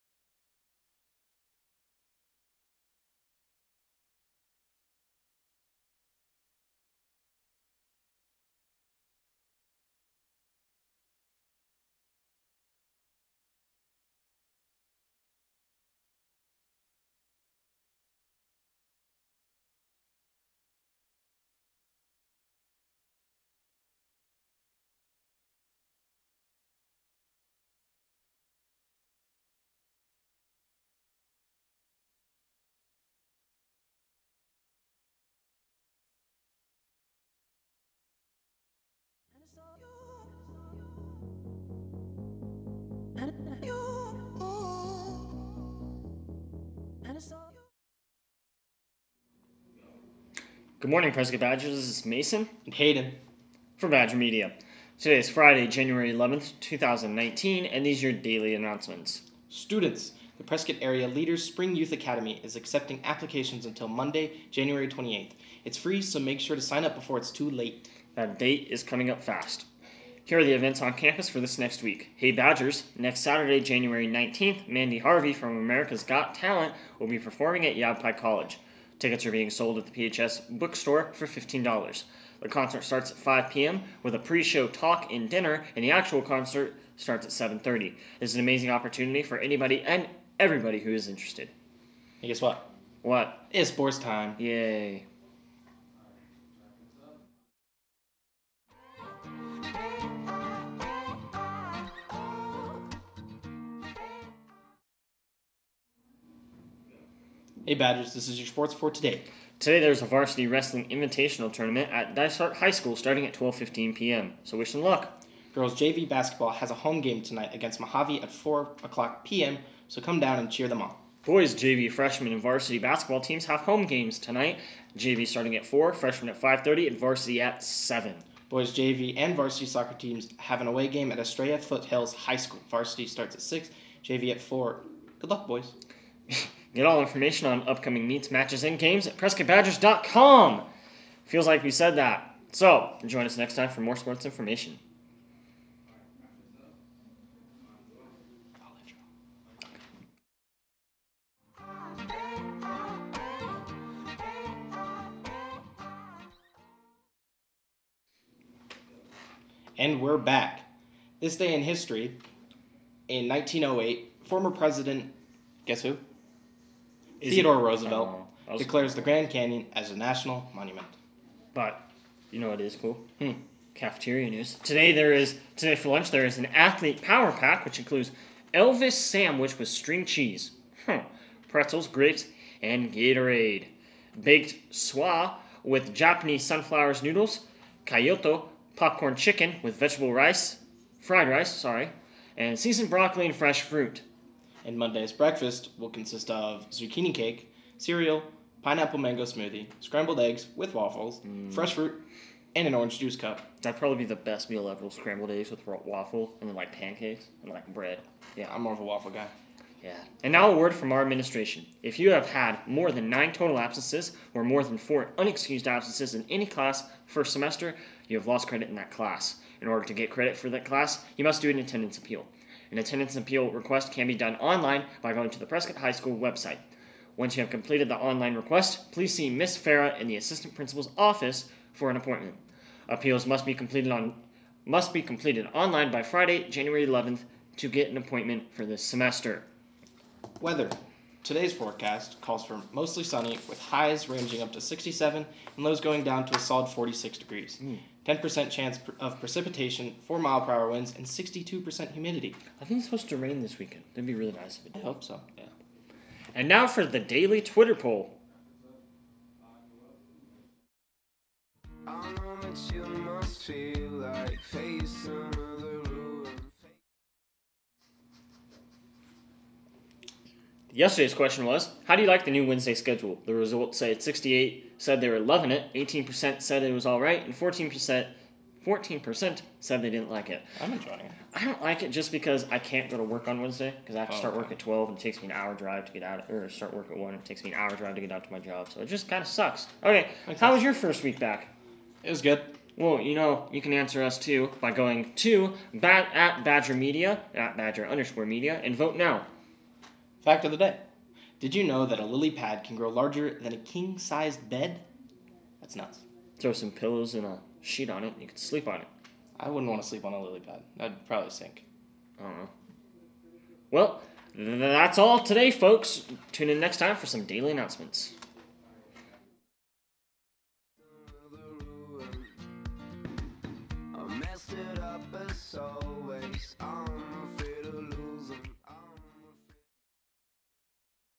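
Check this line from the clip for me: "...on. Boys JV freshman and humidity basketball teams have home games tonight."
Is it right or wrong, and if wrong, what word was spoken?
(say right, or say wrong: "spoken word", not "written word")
wrong: "varsity", not "humidity".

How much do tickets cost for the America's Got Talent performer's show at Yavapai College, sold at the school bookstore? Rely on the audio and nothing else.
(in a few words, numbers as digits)
$15.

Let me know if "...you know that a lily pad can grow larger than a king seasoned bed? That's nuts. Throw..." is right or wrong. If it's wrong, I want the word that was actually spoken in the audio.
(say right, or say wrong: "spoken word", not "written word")
wrong: "sized", not "seasoned".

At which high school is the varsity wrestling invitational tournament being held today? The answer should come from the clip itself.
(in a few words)
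Dysart High School.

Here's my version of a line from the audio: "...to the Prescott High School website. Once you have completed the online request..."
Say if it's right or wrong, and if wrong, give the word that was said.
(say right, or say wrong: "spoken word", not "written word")
right.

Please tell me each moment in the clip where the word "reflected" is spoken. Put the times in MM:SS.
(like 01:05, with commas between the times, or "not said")
not said.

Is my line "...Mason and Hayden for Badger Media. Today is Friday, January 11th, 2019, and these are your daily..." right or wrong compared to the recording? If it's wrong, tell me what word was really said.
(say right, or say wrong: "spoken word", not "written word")
right.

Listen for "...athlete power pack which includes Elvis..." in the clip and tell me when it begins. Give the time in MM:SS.
02:56.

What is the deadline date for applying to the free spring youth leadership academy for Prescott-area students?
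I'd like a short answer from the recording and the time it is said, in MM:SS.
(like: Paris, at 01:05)
January 28th, at 01:03.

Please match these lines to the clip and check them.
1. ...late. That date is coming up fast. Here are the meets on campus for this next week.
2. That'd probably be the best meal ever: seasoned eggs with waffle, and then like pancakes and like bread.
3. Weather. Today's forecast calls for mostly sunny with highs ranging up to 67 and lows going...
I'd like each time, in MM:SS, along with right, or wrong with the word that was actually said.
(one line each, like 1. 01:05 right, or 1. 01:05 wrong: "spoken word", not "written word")
1. 01:07 wrong: "events", not "meets"
2. 03:23 wrong: "scrambled", not "seasoned"
3. 04:00 right.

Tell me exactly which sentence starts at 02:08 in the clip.
Boys JV and varsity soccer teams have an away game at Estrella Foothills High School.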